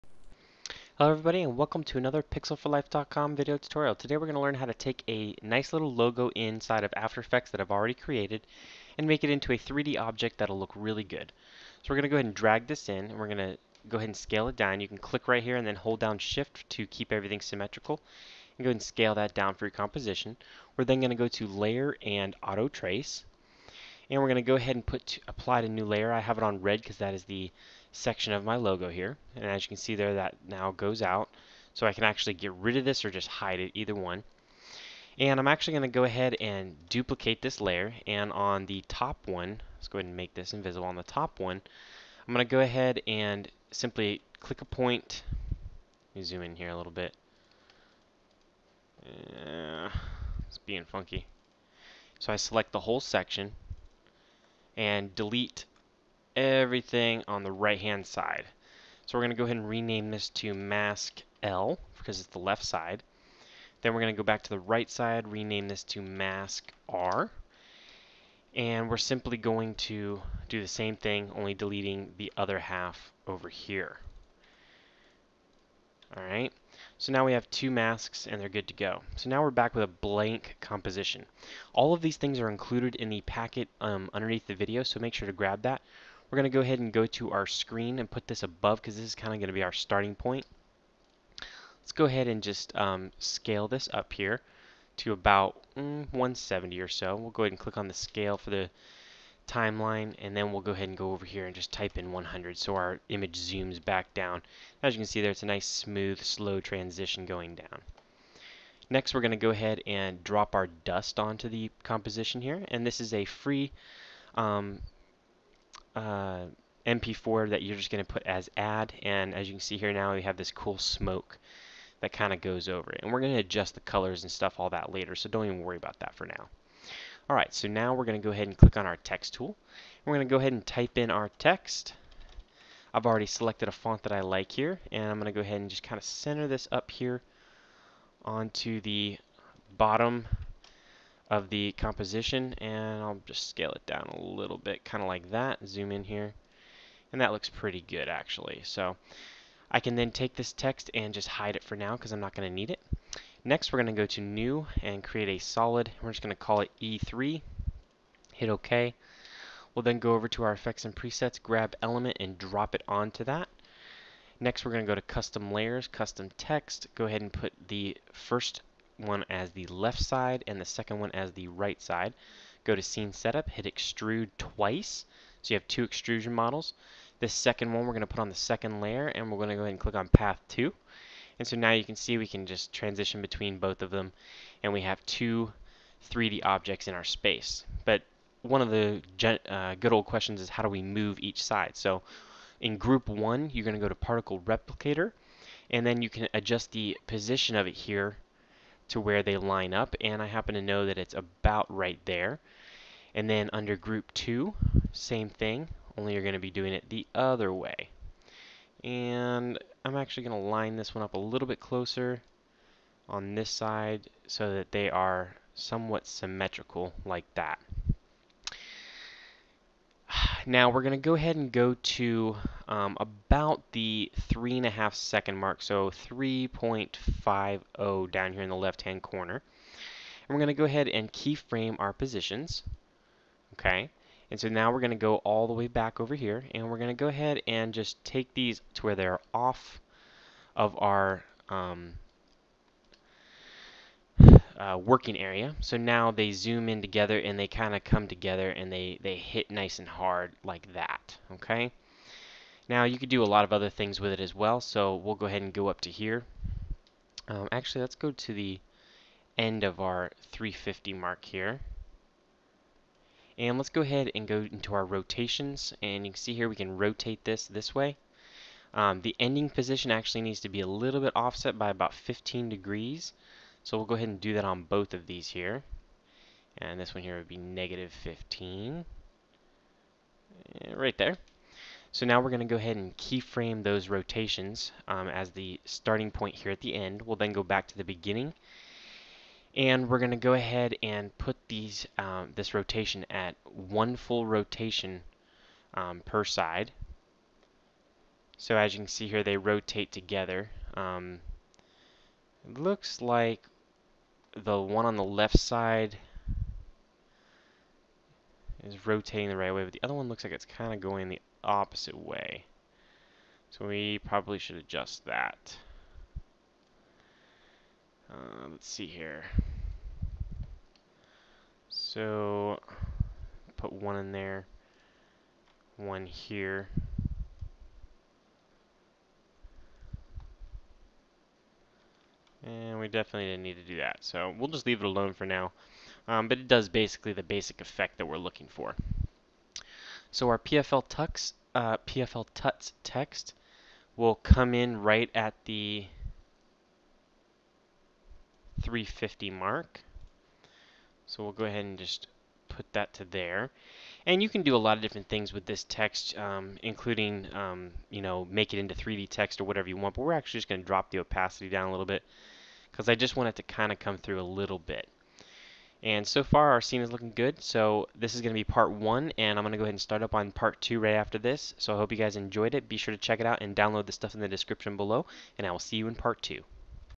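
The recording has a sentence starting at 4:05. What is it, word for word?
So now they zoom in together and they kind of come together and they, they hit nice and hard like that, okay?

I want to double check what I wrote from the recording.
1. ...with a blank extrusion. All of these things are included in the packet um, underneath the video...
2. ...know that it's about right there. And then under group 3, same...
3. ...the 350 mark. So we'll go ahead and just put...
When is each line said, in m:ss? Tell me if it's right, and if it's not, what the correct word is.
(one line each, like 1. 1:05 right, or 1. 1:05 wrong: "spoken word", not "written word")
1. 1:19 wrong: "composition", not "extrusion"
2. 3:20 wrong: "2", not "3"
3. 5:45 right.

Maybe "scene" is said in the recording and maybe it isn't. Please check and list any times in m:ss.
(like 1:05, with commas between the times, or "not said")
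2:52, 6:06.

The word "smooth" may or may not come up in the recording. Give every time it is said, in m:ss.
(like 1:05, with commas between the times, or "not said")
1:45.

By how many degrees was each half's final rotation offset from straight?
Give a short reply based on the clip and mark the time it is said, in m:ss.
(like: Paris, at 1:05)
15, at 4:31.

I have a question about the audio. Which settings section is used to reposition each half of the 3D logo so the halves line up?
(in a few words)
particle replicator.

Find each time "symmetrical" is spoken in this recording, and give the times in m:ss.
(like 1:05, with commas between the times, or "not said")
0:17, 3:36.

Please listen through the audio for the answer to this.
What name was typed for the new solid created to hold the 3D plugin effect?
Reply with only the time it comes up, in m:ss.
2:36.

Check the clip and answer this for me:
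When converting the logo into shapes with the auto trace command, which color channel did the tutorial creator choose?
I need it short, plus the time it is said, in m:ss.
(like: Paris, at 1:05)
red, at 0:26.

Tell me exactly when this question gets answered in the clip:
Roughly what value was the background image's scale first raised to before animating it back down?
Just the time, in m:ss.
1:36.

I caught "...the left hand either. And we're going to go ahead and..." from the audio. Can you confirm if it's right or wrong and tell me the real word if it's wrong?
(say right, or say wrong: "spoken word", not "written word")
wrong: "corner", not "either".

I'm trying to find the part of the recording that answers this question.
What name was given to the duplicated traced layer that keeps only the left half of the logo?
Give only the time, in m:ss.
1:00.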